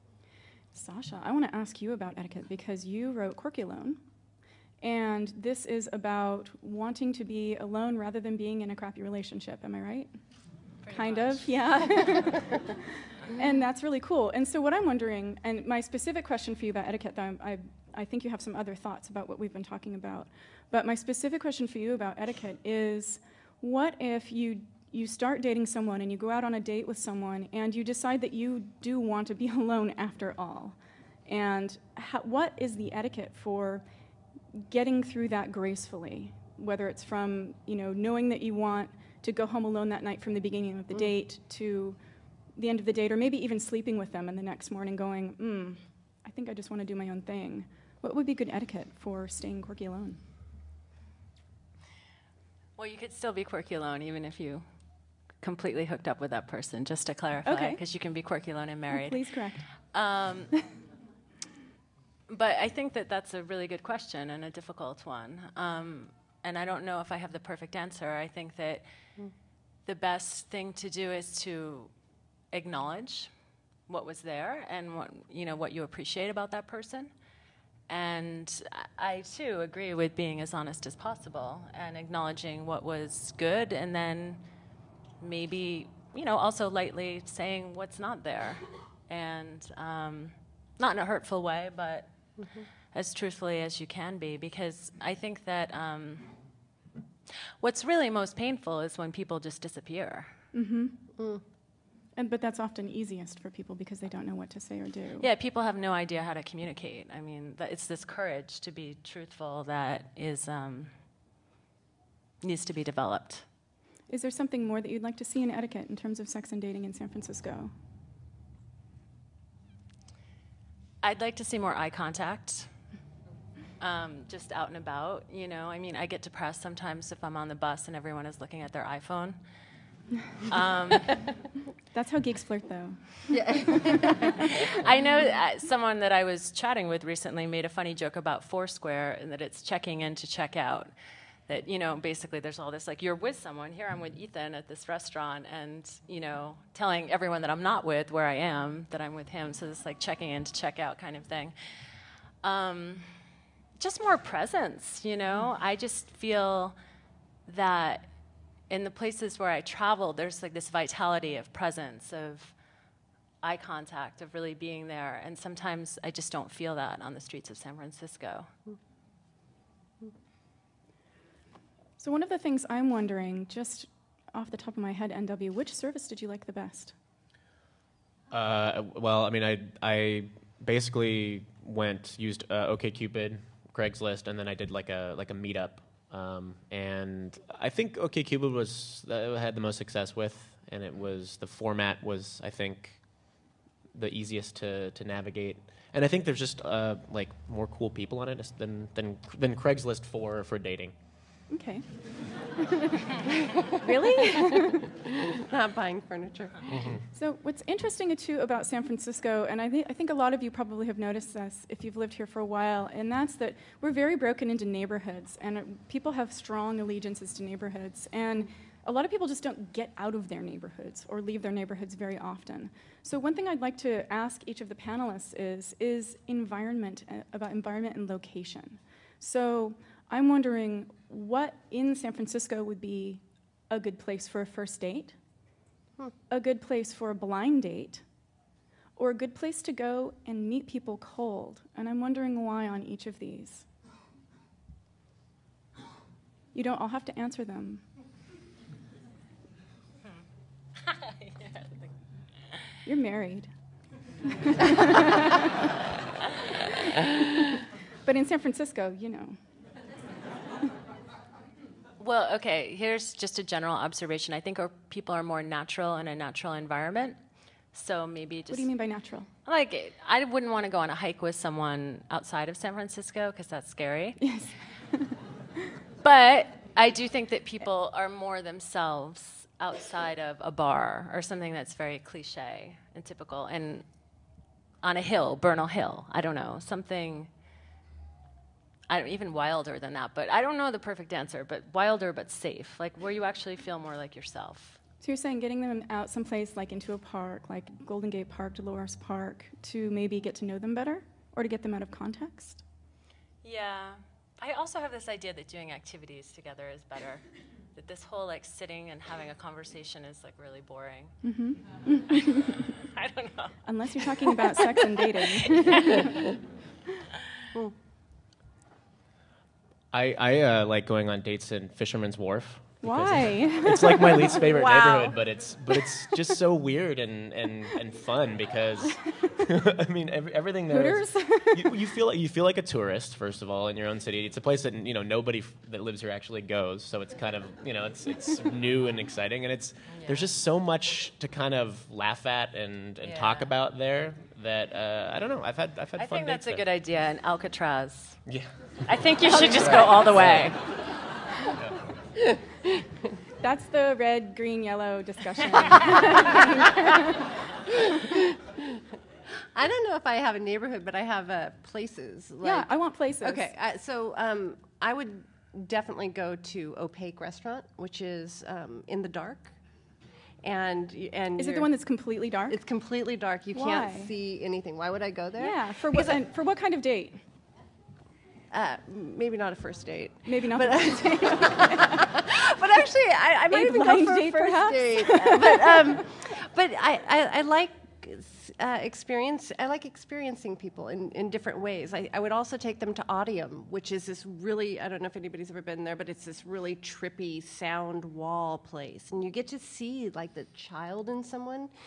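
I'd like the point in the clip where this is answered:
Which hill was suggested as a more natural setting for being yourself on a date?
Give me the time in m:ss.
4:45.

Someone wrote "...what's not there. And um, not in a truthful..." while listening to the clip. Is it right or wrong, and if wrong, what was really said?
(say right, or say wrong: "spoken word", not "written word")
wrong: "hurtful", not "truthful".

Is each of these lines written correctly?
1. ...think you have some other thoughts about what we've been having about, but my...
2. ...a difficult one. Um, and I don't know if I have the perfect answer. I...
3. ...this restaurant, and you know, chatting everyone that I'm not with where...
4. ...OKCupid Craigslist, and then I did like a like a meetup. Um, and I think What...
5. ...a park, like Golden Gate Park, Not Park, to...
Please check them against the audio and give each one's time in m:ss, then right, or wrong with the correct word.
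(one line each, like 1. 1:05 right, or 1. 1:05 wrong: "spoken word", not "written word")
1. 0:18 wrong: "talking", not "having"
2. 1:04 right
3. 2:24 wrong: "telling", not "chatting"
4. 3:02 wrong: "OKCupid", not "What"
5. 4:56 wrong: "Dolores", not "Not".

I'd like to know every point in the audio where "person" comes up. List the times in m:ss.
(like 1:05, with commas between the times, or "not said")
0:56, 1:16.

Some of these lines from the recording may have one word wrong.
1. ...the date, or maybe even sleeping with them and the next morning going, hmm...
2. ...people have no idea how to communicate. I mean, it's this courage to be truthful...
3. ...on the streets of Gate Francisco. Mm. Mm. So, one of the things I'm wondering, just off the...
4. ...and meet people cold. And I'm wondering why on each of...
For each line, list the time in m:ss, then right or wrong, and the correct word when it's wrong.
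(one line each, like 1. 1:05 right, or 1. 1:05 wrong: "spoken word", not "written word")
1. 0:42 right
2. 1:45 right
3. 2:47 wrong: "San", not "Gate"
4. 4:00 right.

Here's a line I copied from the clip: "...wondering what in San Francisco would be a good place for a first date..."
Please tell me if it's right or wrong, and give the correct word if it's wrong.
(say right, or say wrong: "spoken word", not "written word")
right.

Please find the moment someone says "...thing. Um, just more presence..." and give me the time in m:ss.
2:31.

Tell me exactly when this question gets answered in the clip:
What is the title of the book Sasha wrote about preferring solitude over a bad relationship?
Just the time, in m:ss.
0:03.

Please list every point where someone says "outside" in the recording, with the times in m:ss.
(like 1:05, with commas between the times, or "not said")
4:32, 4:39.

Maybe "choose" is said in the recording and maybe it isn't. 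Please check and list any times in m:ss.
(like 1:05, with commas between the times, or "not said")
not said.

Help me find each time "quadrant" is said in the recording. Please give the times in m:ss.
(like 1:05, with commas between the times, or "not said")
not said.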